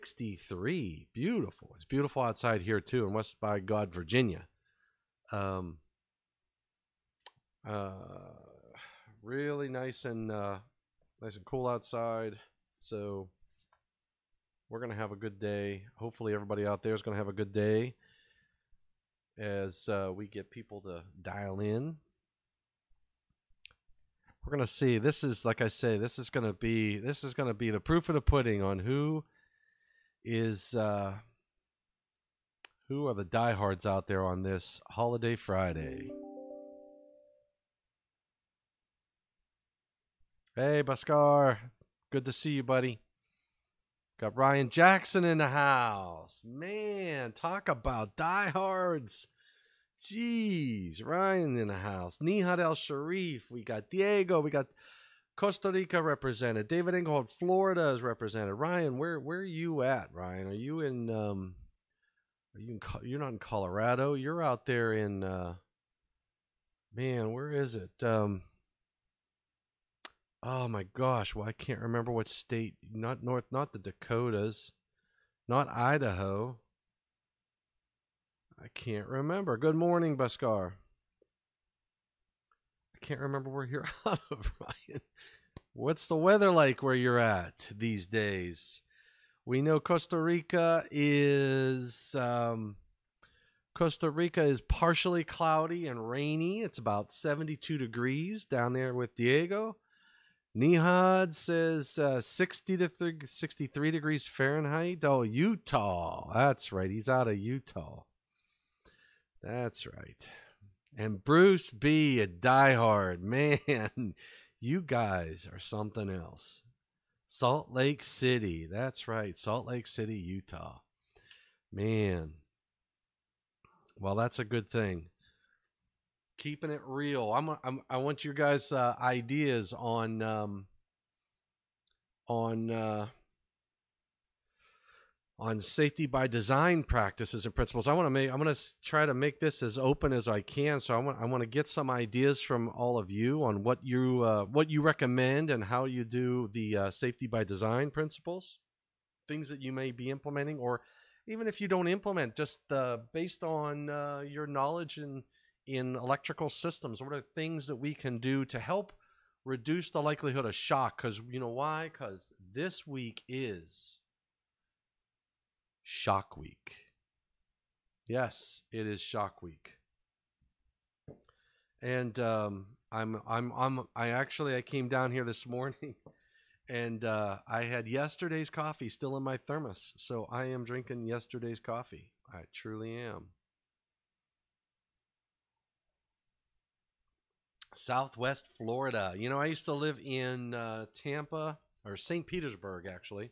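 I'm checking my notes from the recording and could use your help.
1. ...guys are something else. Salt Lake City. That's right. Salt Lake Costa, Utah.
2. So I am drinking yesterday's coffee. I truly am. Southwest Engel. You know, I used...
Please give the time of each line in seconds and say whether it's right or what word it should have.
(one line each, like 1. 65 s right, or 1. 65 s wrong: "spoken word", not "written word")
1. 114 s wrong: "City", not "Costa"
2. 179 s wrong: "Florida", not "Engel".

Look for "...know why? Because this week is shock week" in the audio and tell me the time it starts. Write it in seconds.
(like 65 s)
161 s.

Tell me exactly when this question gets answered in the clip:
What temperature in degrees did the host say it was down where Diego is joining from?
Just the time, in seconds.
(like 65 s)
97 s.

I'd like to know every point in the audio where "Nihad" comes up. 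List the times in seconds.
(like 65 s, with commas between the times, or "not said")
52 s, 100 s.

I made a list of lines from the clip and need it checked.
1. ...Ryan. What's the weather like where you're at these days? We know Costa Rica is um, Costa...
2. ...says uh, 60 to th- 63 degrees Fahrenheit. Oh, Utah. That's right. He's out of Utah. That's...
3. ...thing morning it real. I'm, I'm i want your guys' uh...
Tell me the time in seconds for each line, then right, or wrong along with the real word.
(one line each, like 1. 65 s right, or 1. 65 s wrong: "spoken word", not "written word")
1. 84 s right
2. 101 s right
3. 124 s wrong: "keeping", not "morning".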